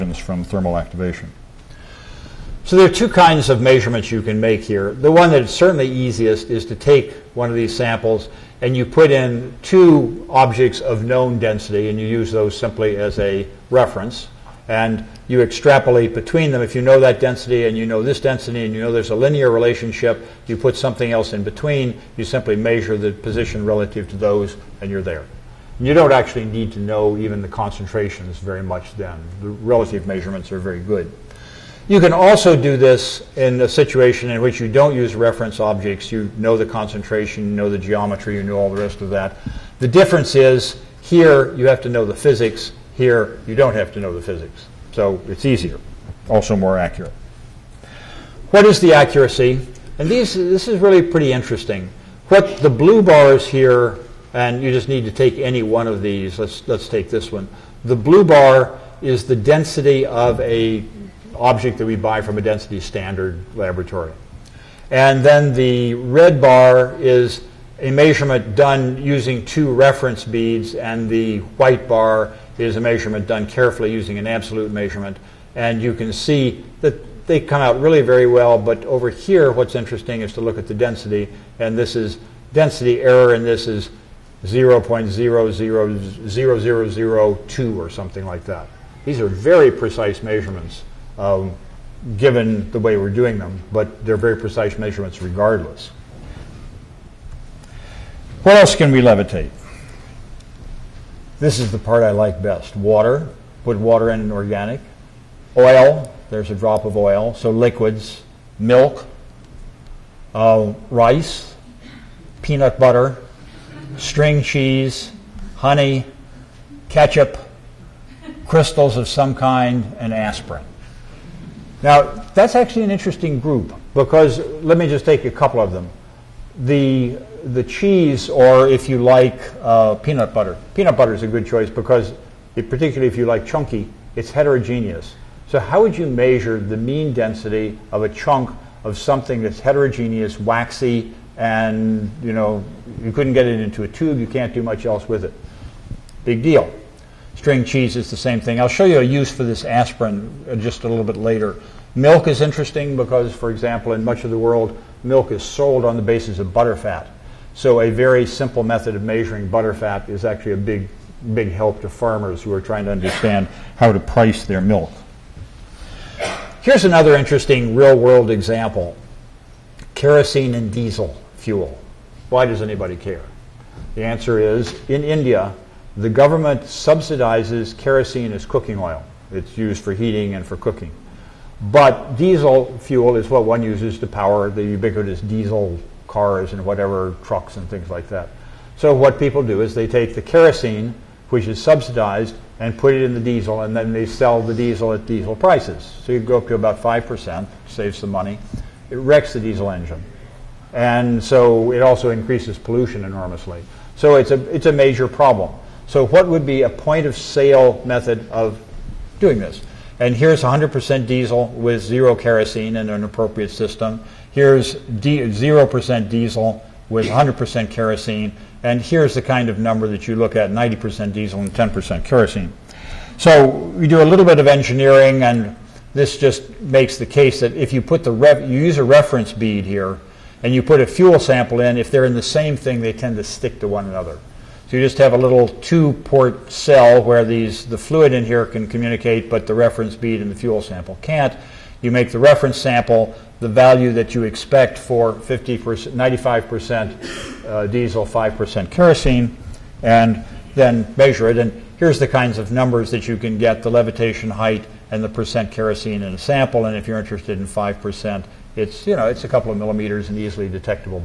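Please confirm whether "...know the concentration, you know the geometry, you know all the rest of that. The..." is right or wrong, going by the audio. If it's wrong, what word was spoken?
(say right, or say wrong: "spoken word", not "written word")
right.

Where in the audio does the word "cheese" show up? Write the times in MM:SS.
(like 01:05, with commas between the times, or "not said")
01:54, 02:07, 02:27.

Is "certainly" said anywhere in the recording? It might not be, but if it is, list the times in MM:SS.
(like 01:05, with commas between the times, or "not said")
00:05.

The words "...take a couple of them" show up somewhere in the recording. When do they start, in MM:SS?
02:05.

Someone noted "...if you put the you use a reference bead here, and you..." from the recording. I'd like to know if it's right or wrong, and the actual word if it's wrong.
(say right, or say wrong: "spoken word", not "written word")
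right.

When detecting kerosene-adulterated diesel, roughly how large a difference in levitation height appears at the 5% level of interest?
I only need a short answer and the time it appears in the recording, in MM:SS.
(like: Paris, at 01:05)
A couple of millimeters, at 04:19.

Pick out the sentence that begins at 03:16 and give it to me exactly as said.
So you go up to about 5%, save some money.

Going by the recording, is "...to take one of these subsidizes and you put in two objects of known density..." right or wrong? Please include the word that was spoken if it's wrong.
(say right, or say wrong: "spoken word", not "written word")
wrong: "samples", not "subsidizes".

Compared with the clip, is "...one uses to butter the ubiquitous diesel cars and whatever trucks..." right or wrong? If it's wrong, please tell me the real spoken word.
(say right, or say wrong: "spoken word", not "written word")
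wrong: "power", not "butter".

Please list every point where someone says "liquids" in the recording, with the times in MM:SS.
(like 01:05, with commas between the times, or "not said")
01:47.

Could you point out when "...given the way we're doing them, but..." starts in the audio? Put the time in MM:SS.
01:32.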